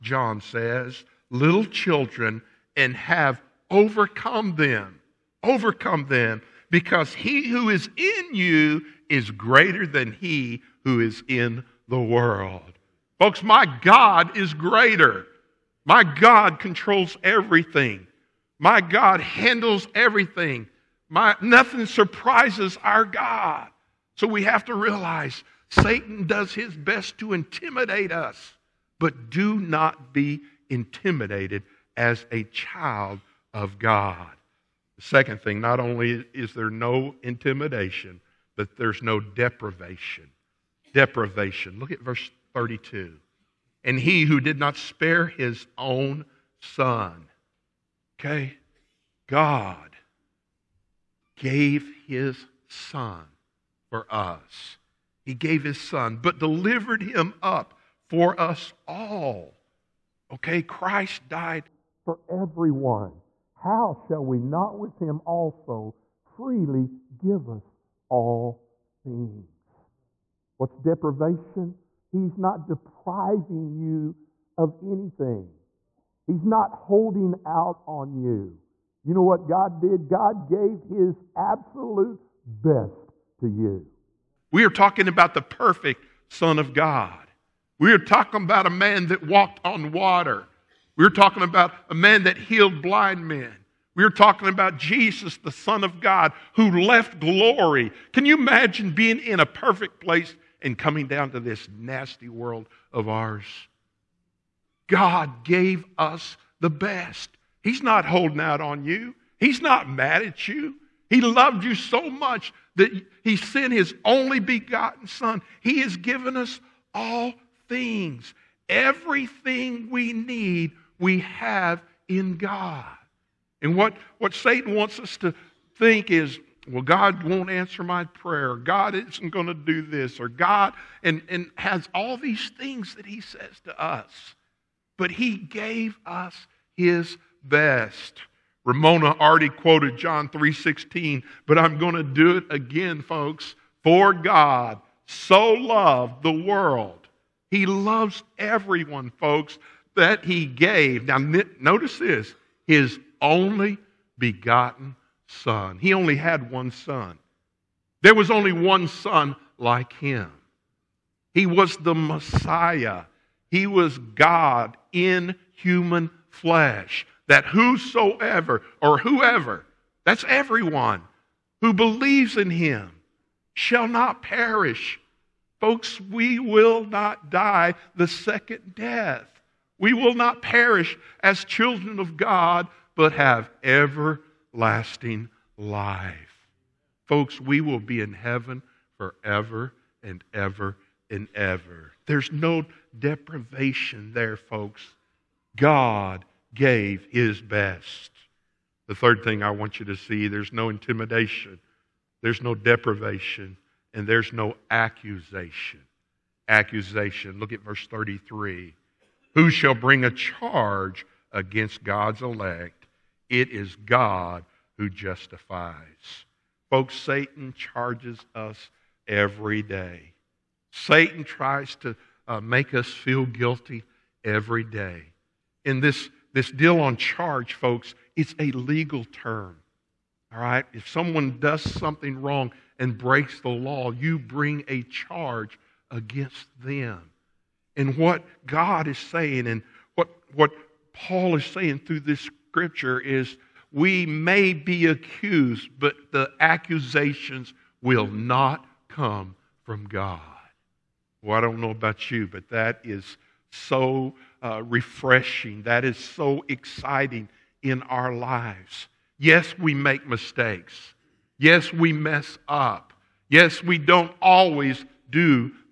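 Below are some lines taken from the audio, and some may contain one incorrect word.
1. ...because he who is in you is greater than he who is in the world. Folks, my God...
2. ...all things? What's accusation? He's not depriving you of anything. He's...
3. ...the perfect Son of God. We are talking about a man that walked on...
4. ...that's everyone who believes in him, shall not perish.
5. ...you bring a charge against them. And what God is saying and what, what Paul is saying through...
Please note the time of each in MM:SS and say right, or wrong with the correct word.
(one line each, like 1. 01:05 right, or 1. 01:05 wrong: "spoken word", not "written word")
1. 00:06 right
2. 01:08 wrong: "deprivation", not "accusation"
3. 01:25 right
4. 02:50 right
5. 03:53 right.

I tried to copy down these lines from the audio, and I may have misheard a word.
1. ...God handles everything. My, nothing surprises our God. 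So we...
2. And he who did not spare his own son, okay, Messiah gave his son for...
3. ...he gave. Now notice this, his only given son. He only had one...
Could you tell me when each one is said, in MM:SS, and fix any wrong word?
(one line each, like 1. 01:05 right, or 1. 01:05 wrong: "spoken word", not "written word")
1. 00:18 right
2. 00:43 wrong: "God", not "Messiah"
3. 02:30 wrong: "begotten", not "given".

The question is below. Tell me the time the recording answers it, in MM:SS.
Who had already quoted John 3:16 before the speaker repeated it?
02:18.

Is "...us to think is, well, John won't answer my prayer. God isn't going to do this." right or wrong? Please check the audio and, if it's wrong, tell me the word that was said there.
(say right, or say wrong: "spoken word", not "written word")
wrong: "God", not "John".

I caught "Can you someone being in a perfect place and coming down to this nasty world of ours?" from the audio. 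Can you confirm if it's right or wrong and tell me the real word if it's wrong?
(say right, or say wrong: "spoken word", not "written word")
wrong: "imagine", not "someone".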